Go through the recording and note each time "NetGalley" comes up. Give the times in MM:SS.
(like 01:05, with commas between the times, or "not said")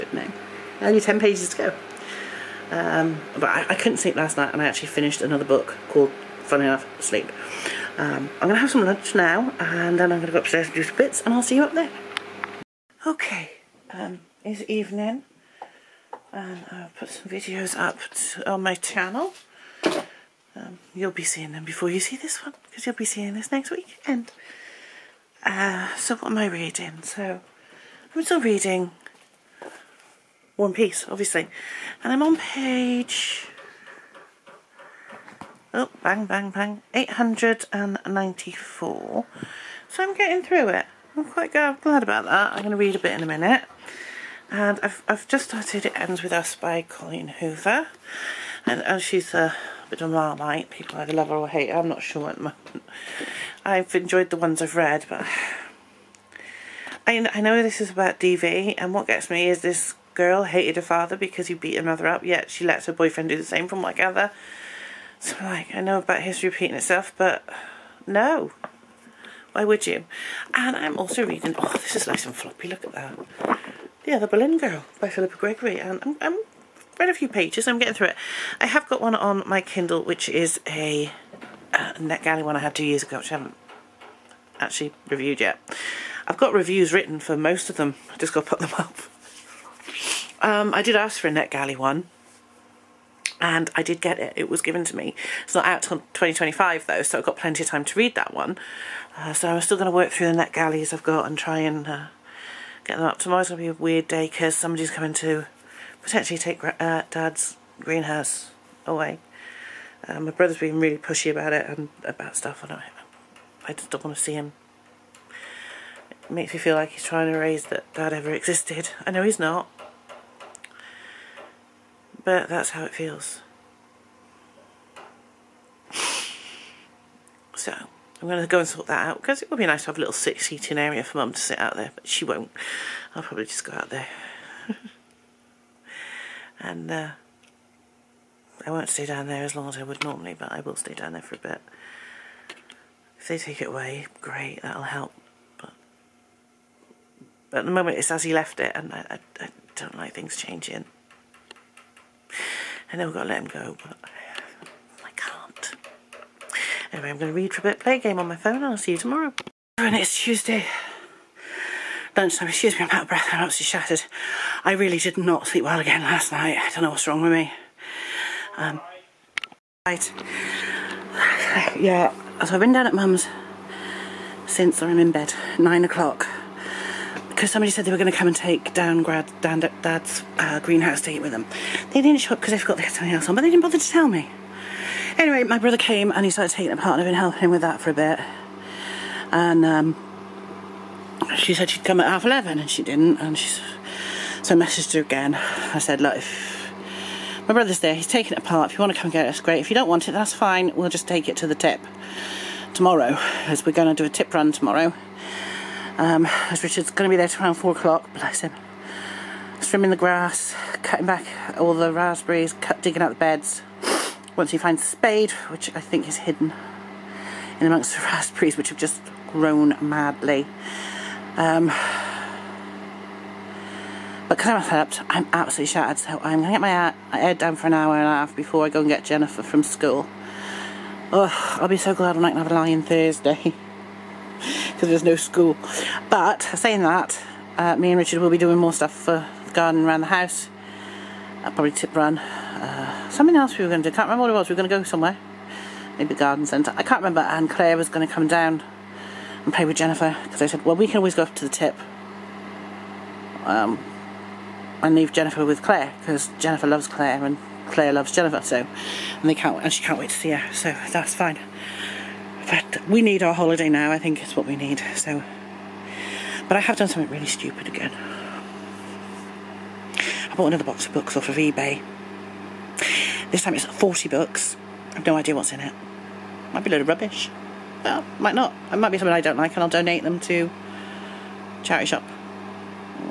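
01:21, 01:31.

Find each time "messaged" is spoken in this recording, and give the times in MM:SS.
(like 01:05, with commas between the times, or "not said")
03:14.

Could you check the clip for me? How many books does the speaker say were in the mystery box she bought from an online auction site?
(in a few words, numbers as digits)
40.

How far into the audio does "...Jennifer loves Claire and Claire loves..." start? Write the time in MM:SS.
04:16.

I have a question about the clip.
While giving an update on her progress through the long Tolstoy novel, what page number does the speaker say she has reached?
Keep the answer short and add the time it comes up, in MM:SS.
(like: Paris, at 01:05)
894, at 00:36.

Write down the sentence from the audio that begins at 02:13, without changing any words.
I'll probably just go out there.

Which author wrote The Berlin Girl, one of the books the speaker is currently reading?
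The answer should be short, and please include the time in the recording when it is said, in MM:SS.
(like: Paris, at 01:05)
Philippa Gregory, at 01:15.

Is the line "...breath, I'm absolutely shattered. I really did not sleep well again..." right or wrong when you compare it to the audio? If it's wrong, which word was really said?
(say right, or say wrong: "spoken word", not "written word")
right.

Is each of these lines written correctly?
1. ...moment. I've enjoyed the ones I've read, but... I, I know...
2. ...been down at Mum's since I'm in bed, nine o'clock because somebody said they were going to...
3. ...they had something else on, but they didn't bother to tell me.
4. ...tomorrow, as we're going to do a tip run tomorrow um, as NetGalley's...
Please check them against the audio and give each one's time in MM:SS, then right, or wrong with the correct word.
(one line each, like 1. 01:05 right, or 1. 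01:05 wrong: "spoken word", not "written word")
1. 00:52 right
2. 02:52 right
3. 03:02 right
4. 03:22 wrong: "Richard", not "NetGalley".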